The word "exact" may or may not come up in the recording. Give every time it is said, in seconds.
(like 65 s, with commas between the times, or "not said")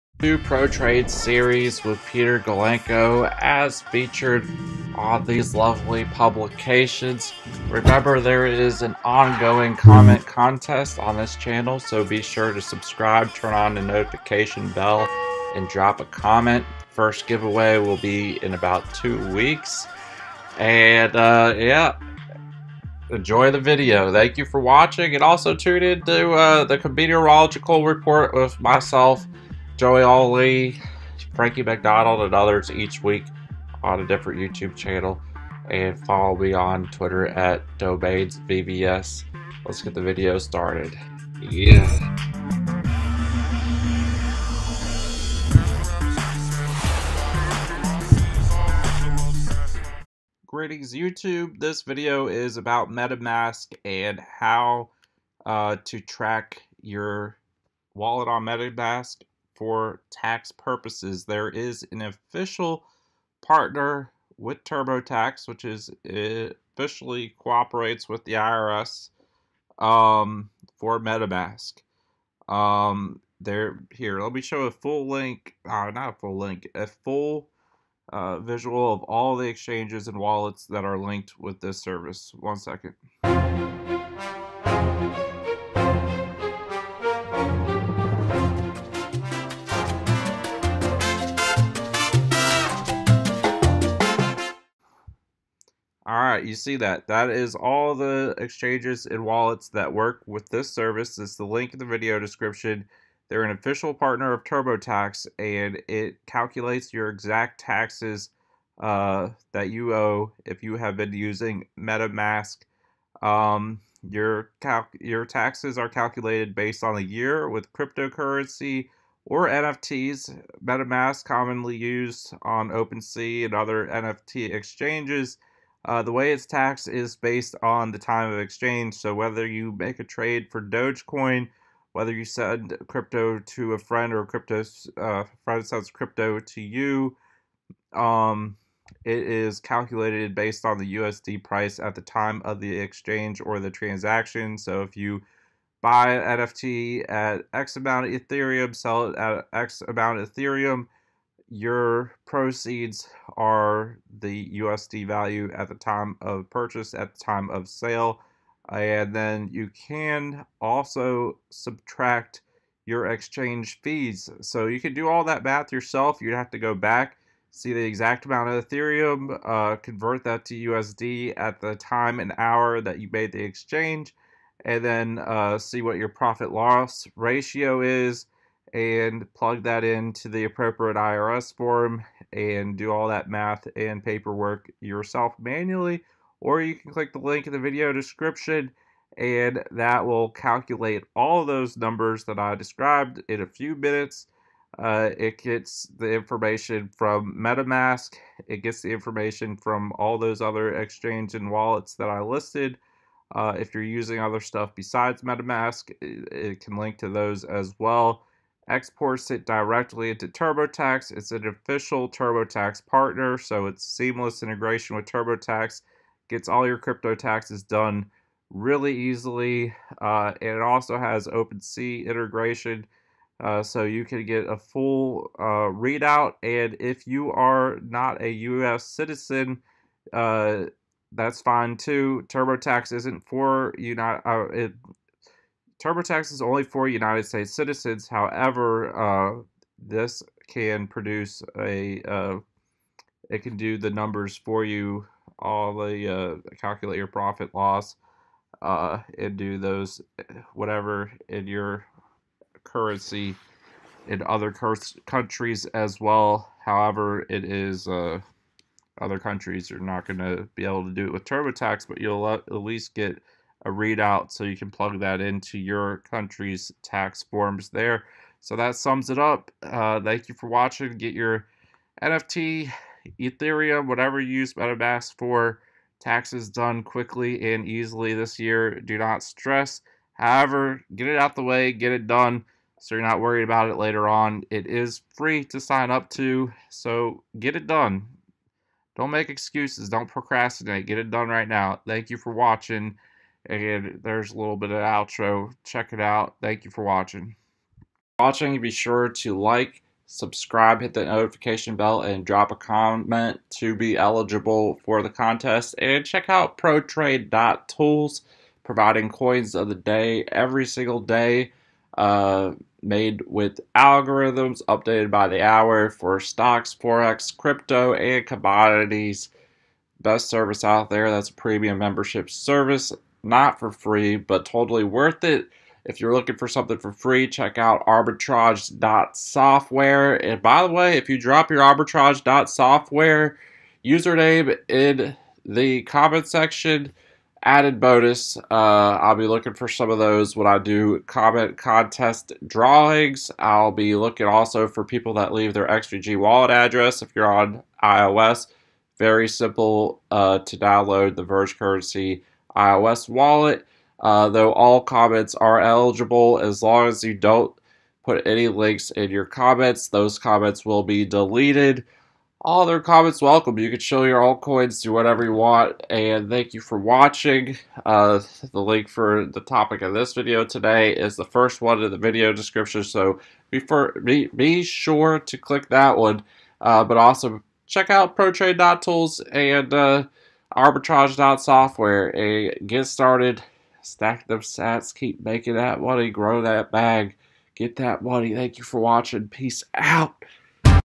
107 s, 167 s.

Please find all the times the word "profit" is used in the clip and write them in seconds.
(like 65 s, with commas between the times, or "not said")
176 s, 247 s.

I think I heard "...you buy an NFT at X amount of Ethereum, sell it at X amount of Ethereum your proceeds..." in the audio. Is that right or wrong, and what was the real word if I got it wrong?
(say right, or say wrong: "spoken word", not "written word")
right.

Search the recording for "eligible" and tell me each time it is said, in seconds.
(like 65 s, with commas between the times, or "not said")
303 s, 355 s.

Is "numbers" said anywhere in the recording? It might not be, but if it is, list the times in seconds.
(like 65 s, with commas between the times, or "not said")
191 s, 243 s.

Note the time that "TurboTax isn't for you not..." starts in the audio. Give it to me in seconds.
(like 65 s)
232 s.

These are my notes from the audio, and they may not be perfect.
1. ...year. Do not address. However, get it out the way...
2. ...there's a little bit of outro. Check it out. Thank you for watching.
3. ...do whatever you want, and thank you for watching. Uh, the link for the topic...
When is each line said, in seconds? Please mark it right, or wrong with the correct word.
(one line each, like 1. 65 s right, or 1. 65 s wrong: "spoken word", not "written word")
1. 278 s wrong: "stress", not "address"
2. 294 s right
3. 364 s right.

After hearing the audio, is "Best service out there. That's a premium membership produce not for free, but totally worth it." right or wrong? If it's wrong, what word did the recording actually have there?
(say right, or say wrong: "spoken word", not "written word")
wrong: "service", not "produce".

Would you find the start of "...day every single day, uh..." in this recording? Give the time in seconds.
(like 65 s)
309 s.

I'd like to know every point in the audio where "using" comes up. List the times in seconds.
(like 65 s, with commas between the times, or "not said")
111 s, 203 s.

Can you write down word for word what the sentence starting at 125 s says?
Uh, the way it's taxed is based on the time of exchange.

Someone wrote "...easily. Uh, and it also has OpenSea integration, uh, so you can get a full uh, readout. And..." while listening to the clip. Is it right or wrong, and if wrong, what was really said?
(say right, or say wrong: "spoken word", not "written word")
right.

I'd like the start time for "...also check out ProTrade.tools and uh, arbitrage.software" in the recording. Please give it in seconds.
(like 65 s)
376 s.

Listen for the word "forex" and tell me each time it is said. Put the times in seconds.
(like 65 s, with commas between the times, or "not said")
316 s.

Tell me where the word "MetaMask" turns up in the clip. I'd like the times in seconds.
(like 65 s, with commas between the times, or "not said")
52 s, 58 s, 70 s, 111 s, 120 s, 197 s, 205 s, 274 s.